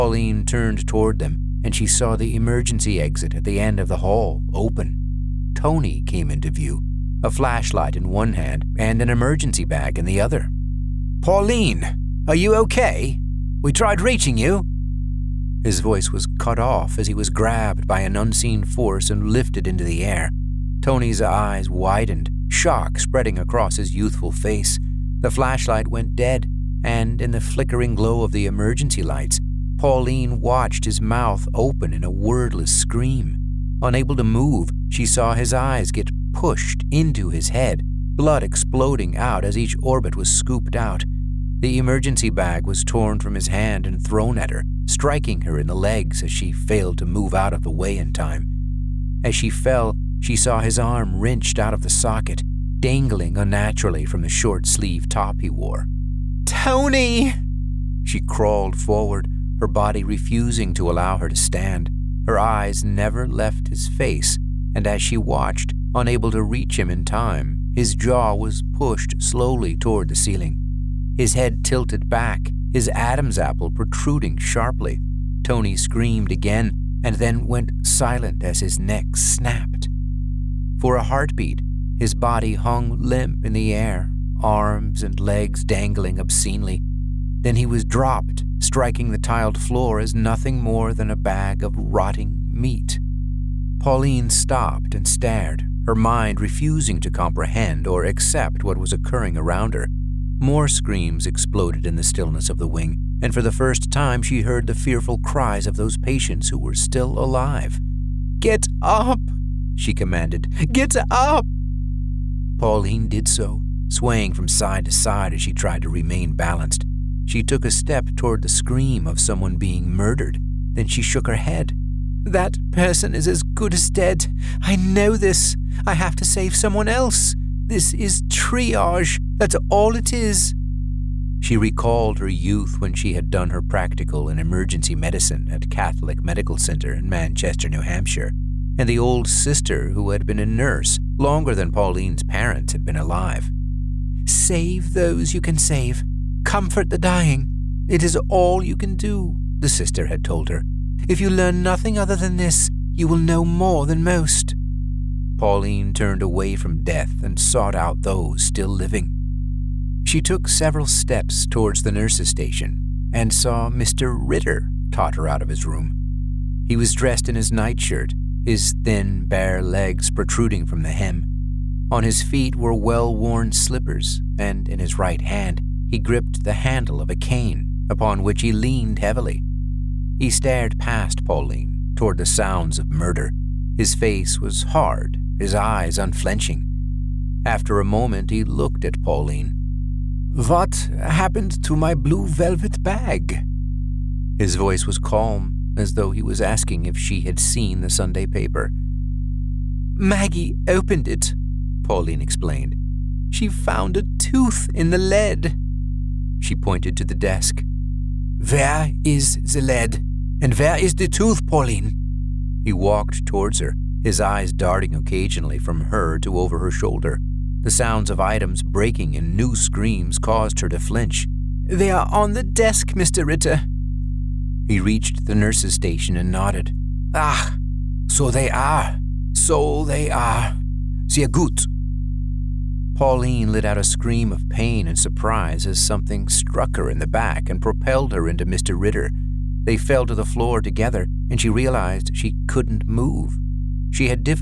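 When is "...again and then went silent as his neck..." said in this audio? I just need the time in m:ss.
1:16.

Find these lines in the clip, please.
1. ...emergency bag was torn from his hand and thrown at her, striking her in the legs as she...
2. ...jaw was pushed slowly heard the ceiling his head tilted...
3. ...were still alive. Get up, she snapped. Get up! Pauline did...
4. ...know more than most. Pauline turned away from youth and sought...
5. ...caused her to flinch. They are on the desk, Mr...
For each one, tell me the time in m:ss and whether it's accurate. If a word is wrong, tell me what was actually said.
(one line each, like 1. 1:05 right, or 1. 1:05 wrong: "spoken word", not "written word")
1. 0:41 right
2. 1:07 wrong: "toward", not "heard"
3. 1:46 wrong: "commanded", not "snapped"
4. 2:33 wrong: "death", not "youth"
5. 3:40 right.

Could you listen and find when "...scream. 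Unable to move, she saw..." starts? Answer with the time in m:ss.
0:32.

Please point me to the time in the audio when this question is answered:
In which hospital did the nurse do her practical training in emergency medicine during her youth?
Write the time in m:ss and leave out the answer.
2:15.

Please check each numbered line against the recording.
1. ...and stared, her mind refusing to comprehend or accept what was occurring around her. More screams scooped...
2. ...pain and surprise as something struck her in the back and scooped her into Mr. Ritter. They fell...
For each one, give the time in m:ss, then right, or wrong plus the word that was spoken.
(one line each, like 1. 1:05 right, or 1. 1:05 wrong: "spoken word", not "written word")
1. 1:34 wrong: "exploded", not "scooped"
2. 3:54 wrong: "propelled", not "scooped".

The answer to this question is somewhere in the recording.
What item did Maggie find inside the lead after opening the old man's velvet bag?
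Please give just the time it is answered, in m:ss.
3:23.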